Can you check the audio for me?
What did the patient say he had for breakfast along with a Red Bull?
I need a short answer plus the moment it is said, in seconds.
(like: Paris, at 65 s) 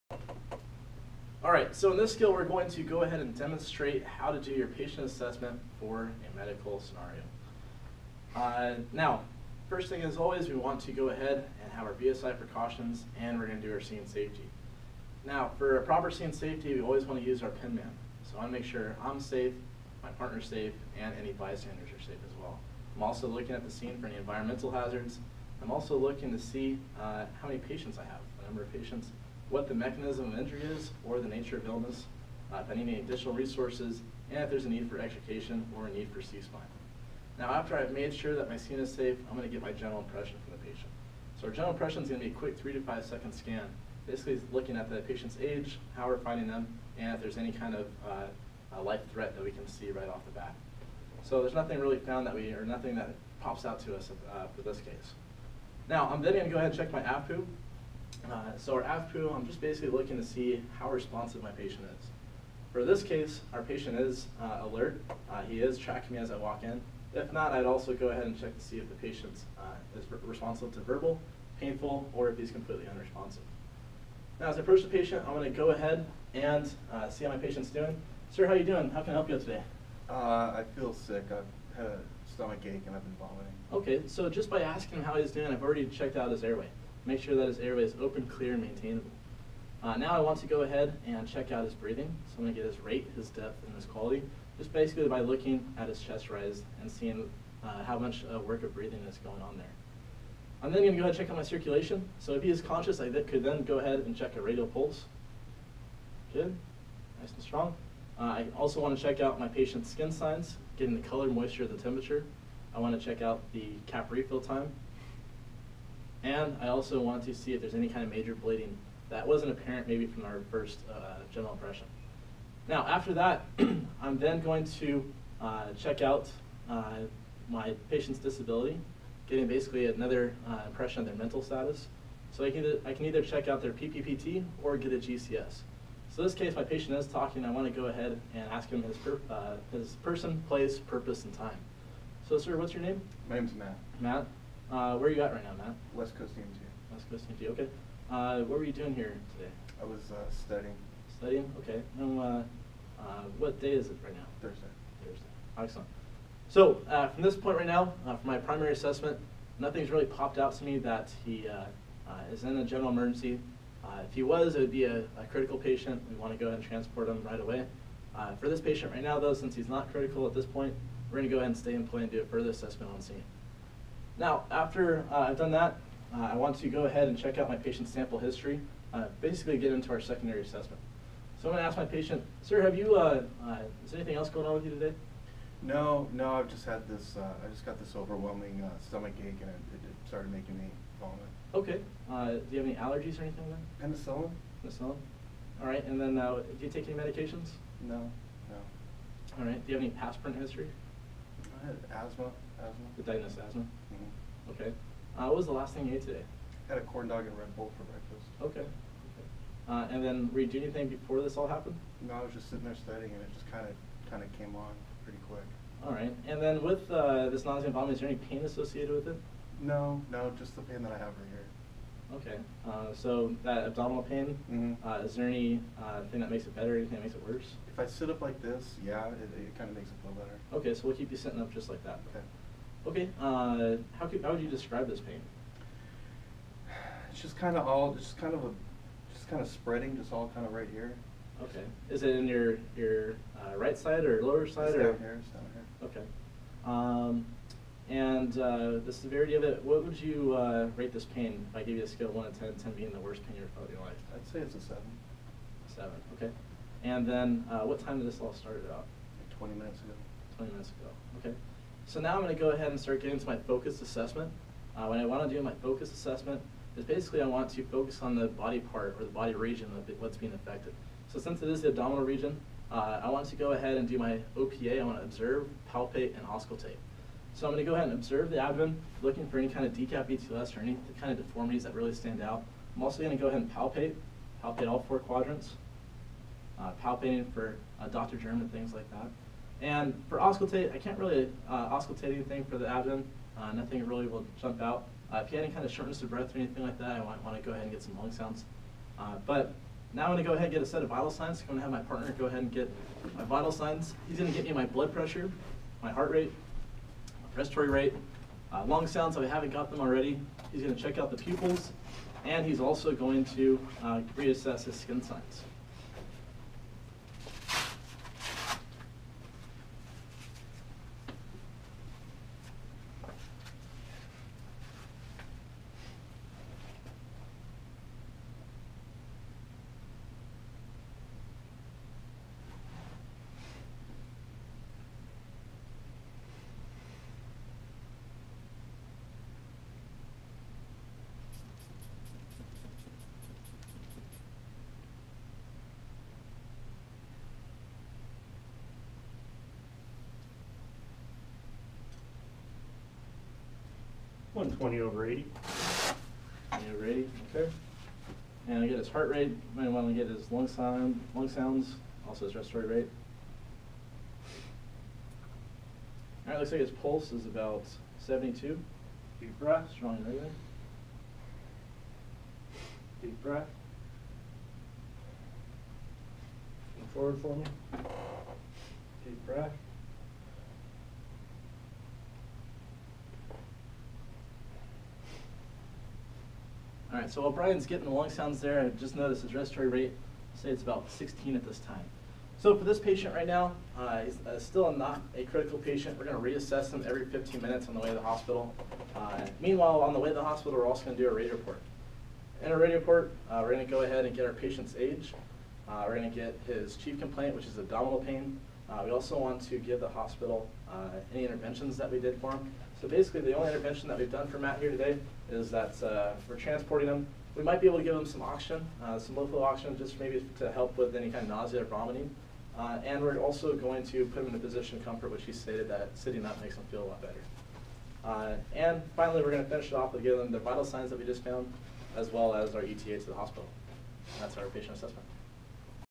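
corn dog, at 206 s.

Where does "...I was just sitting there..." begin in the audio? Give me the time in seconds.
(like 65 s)
212 s.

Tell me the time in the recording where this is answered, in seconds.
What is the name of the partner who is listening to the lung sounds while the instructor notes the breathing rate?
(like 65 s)
387 s.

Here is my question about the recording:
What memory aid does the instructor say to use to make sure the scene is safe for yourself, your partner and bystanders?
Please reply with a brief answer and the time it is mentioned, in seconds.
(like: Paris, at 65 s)
pin man, at 17 s.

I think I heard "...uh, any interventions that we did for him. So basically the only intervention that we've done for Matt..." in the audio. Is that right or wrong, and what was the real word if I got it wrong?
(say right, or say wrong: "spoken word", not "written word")
right.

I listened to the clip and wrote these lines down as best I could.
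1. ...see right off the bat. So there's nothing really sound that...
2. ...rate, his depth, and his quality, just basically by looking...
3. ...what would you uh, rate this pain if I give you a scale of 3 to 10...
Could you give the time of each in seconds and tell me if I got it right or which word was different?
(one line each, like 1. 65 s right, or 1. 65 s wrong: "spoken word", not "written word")
1. 49 s wrong: "found", not "sound"
2. 92 s right
3. 249 s wrong: "1", not "3".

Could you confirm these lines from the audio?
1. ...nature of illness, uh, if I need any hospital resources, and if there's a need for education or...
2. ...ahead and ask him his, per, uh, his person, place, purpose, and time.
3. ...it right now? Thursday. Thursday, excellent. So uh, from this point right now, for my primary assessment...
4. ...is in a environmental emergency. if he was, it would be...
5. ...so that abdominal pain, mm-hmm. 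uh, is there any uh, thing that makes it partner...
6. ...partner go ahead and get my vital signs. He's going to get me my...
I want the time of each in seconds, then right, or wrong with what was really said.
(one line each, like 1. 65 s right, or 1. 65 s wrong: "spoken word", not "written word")
1. 31 s wrong: "additional", not "hospital"
2. 137 s right
3. 153 s right
4. 162 s wrong: "general", not "environmental"
5. 222 s wrong: "better", not "partner"
6. 301 s right.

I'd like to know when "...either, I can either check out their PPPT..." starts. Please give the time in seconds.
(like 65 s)
132 s.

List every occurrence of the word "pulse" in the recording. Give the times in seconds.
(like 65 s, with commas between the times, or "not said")
104 s, 366 s.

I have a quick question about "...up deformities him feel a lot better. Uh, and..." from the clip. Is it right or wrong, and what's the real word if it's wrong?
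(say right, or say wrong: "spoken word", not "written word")
wrong: "makes", not "deformities".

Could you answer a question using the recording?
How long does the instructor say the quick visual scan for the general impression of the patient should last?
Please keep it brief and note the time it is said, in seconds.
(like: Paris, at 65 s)
3 to 5 seconds, at 42 s.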